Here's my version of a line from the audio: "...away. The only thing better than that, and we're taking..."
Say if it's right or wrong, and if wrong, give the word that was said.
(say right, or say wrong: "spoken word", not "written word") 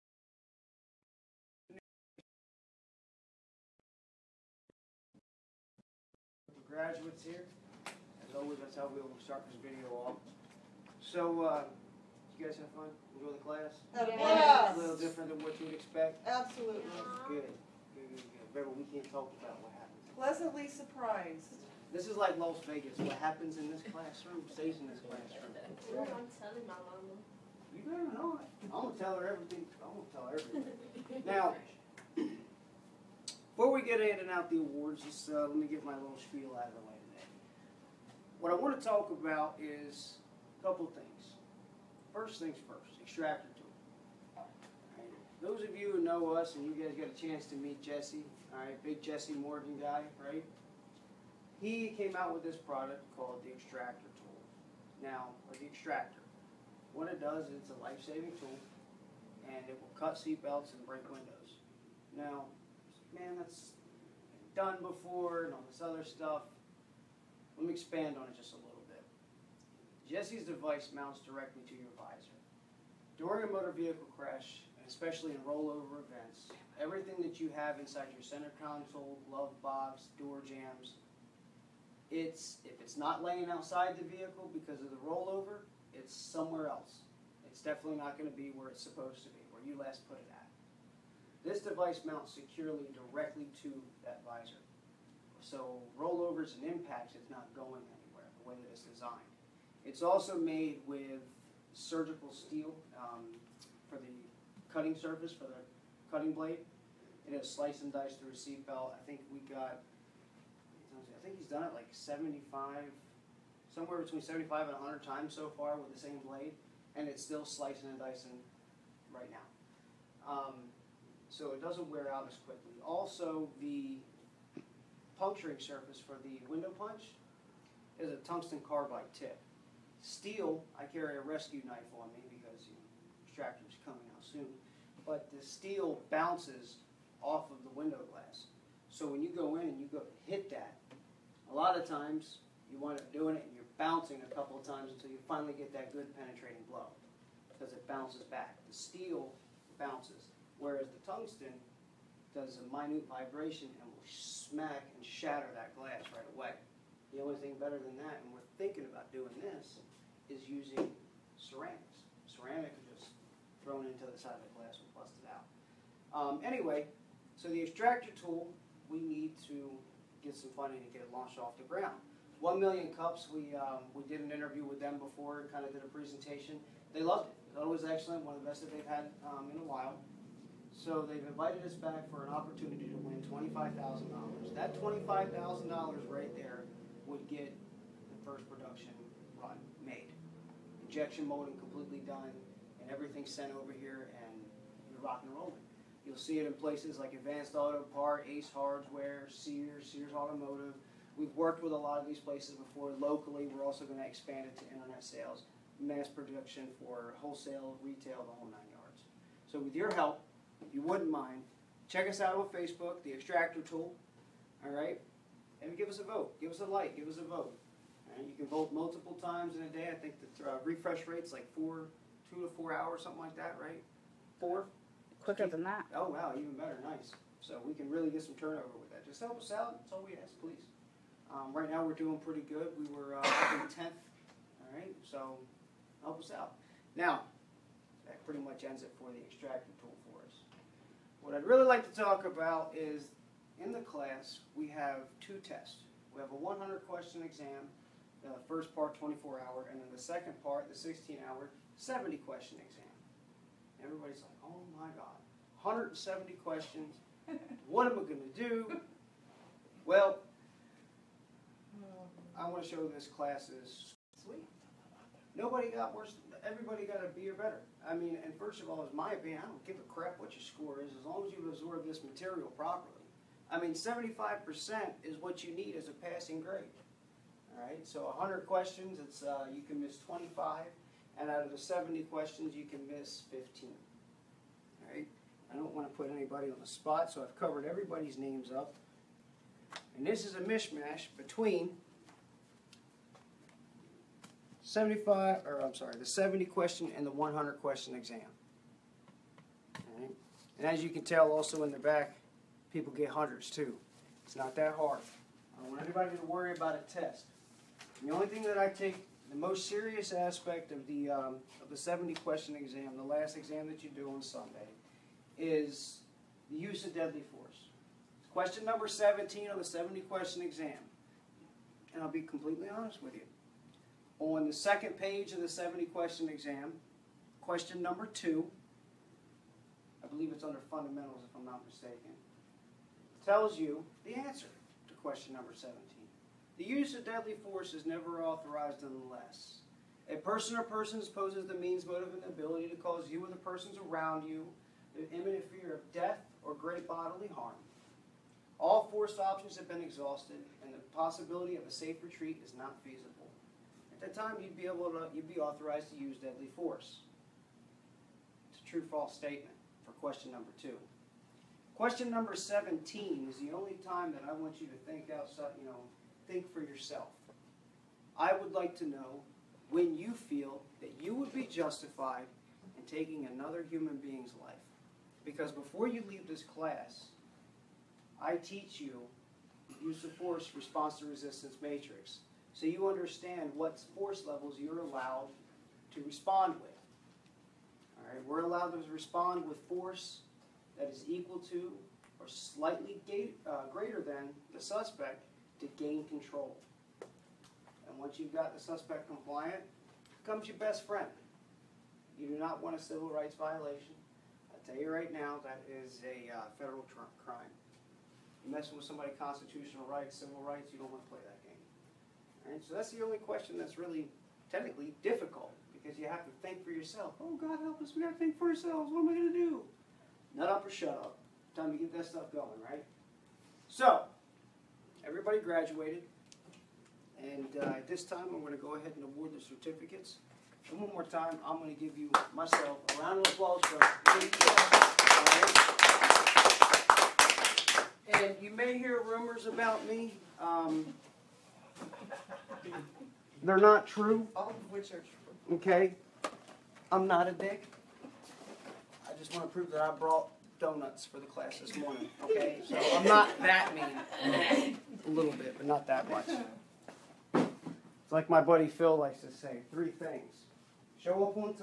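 wrong: "thinking", not "taking".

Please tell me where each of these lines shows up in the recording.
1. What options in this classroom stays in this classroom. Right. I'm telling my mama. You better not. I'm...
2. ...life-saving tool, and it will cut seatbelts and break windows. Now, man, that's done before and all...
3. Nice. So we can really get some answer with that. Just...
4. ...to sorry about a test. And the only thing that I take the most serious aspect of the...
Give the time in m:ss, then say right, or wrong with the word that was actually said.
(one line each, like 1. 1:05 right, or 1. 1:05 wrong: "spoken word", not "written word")
1. 0:22 wrong: "happens", not "options"
2. 0:57 right
3. 3:46 wrong: "turnover", not "answer"
4. 5:06 wrong: "worry", not "sorry".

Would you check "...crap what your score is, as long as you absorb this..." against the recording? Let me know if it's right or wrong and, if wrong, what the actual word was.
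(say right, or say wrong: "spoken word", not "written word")
right.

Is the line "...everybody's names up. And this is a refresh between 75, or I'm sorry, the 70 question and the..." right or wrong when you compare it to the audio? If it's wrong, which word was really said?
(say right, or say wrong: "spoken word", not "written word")
wrong: "mishmash", not "refresh".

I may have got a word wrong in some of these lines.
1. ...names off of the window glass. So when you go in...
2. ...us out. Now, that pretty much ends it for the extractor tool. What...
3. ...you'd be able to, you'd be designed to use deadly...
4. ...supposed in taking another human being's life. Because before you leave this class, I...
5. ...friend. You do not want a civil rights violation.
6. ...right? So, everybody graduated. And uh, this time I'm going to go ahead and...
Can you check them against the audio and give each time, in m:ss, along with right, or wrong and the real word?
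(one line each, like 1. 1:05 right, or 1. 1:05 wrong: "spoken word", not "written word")
1. 2:16 wrong: "bounces", not "names"
2. 3:56 right
3. 5:54 wrong: "authorized", not "designed"
4. 6:11 wrong: "justified", not "supposed"
5. 6:40 right
6. 7:02 right.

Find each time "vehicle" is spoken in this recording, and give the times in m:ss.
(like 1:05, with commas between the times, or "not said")
1:13, 1:24.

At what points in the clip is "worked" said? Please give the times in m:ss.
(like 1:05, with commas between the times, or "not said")
3:21.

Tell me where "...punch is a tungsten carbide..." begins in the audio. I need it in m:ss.
2:06.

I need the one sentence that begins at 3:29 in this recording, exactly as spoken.
So with your help, if you wouldn't mind, check us out on Facebook, The Extractor Tool, all right?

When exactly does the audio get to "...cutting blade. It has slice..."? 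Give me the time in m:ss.
1:46.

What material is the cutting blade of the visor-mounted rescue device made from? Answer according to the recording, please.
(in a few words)
surgical steel.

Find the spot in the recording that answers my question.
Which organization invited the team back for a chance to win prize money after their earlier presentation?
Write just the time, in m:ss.
2:52.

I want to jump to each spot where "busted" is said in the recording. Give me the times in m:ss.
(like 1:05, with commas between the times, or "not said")
2:44.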